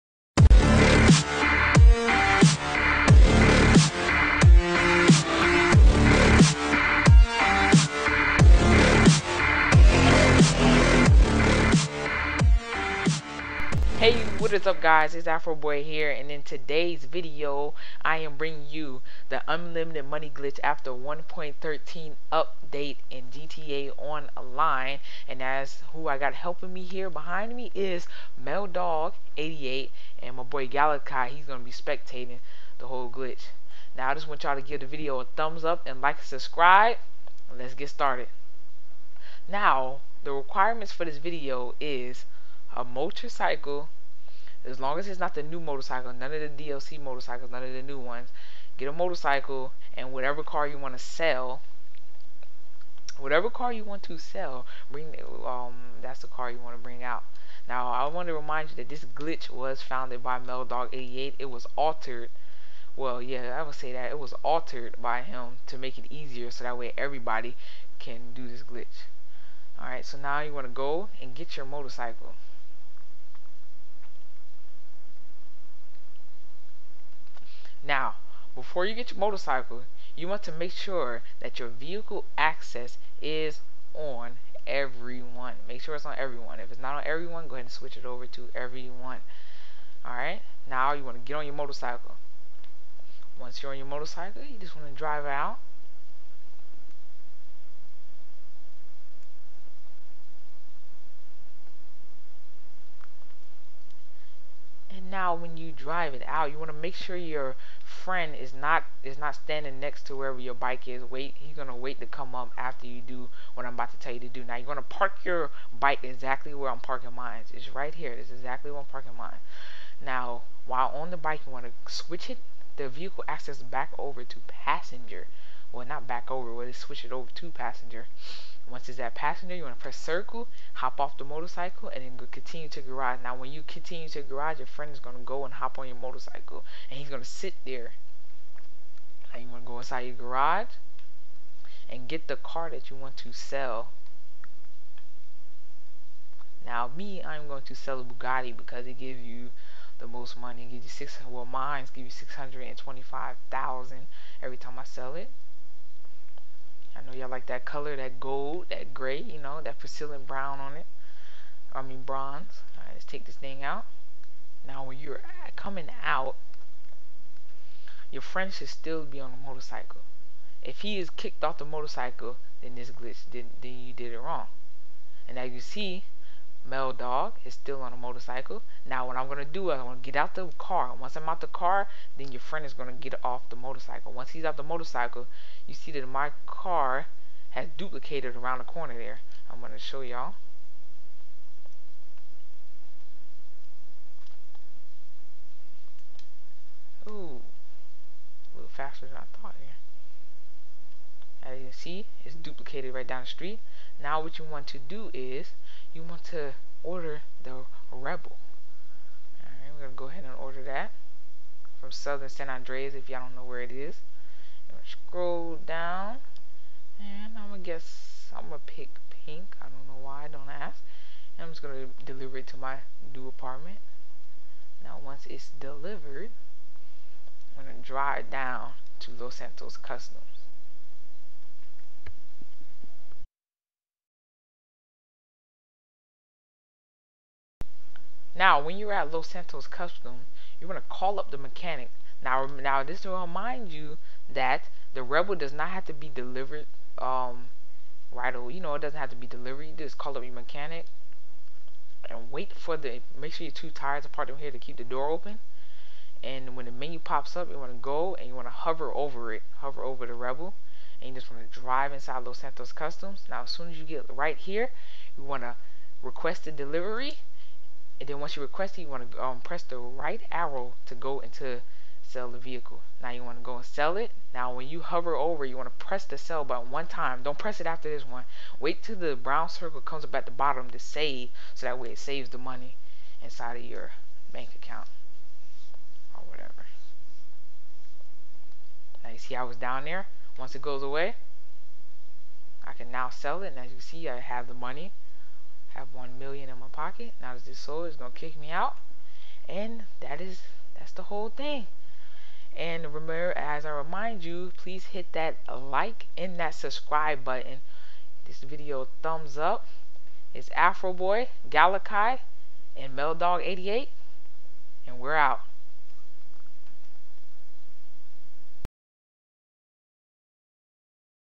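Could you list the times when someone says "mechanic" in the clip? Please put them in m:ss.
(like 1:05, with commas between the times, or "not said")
4:01, 4:10.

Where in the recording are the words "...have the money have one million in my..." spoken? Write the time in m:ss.
4:54.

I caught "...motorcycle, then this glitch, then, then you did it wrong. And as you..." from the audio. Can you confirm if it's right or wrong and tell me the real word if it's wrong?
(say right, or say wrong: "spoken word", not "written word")
right.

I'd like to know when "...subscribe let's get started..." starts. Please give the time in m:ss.
0:36.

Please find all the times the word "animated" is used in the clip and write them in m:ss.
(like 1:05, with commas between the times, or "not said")
not said.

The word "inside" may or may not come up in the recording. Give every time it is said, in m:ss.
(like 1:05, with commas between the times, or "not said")
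2:19, 4:21, 4:43.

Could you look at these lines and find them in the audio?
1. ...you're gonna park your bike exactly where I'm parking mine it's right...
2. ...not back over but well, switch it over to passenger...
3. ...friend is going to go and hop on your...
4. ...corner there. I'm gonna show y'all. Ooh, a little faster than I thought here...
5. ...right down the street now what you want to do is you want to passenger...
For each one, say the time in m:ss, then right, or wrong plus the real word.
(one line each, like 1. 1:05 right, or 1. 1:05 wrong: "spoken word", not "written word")
1. 1:54 right
2. 2:05 right
3. 2:14 right
4. 3:08 right
5. 3:22 wrong: "order", not "passenger".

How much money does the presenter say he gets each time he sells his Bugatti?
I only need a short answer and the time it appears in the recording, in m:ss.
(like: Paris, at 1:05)
625,000, at 2:32.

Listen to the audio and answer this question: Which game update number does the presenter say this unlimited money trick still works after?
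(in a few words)
1.13.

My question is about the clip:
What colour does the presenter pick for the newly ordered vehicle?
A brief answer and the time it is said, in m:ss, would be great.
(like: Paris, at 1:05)
pink, at 3:39.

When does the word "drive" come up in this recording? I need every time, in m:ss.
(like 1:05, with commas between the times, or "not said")
1:34, 1:45, 3:47, 4:21.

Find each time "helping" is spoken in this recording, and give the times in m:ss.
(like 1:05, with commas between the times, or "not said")
0:26.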